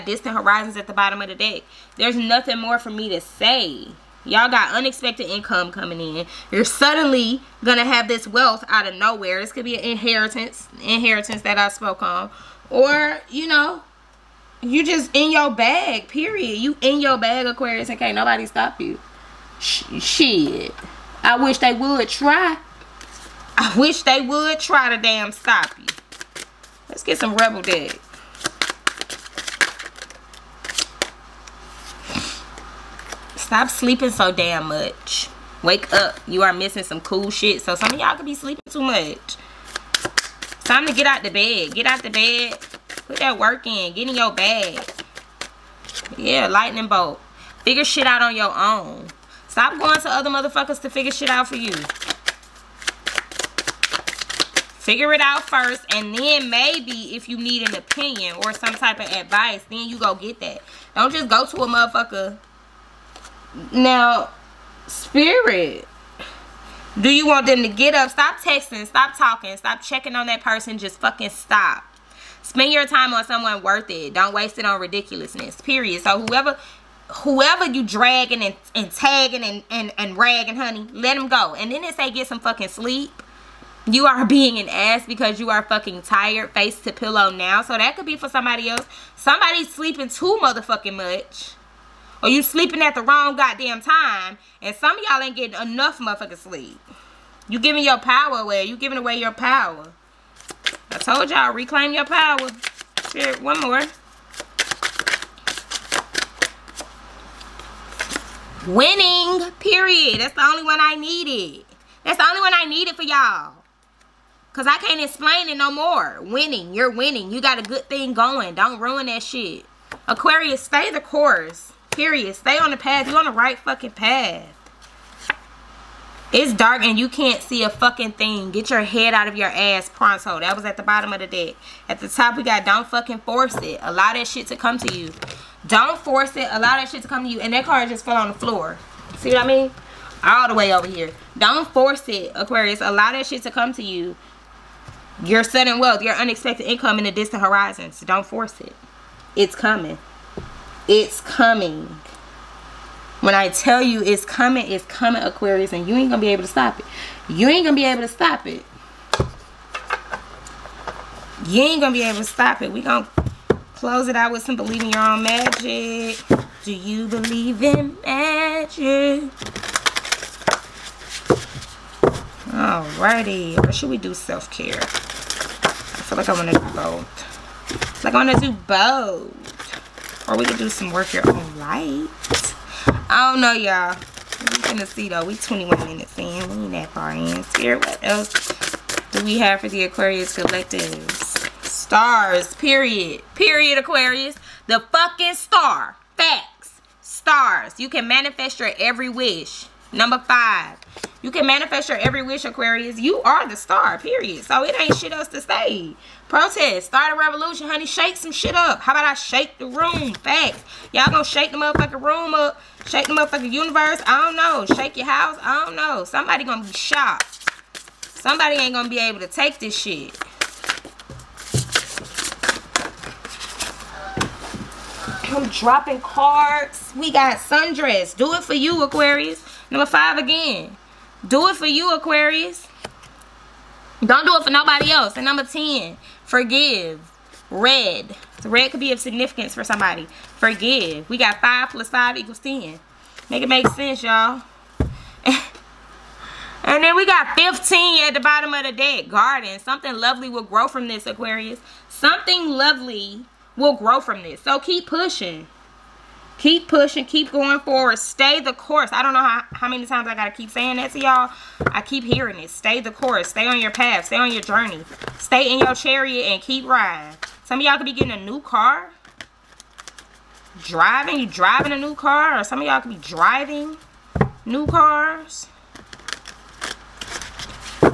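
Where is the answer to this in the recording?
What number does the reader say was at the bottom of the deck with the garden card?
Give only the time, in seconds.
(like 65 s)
247 s.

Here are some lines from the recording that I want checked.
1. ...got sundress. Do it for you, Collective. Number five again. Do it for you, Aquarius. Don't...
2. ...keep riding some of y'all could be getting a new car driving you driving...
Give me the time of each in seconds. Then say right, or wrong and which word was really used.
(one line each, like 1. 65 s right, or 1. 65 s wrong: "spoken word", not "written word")
1. 227 s wrong: "Aquarius", not "Collective"
2. 266 s right.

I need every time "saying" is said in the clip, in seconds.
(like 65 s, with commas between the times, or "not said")
260 s.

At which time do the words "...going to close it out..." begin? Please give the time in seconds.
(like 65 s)
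162 s.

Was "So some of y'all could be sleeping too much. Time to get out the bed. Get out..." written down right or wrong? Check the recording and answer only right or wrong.
right.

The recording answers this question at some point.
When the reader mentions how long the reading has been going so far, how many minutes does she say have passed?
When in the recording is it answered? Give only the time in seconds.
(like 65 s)
185 s.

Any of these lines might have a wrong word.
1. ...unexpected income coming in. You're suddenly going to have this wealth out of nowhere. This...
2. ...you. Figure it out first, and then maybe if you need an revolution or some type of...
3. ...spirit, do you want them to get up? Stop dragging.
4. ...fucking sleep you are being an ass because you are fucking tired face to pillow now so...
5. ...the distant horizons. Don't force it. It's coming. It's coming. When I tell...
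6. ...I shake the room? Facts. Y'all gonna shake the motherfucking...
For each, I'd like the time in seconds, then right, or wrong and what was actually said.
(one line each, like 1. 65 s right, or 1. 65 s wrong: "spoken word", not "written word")
1. 4 s right
2. 51 s wrong: "opinion", not "revolution"
3. 64 s wrong: "texting", not "dragging"
4. 82 s right
5. 147 s right
6. 209 s right.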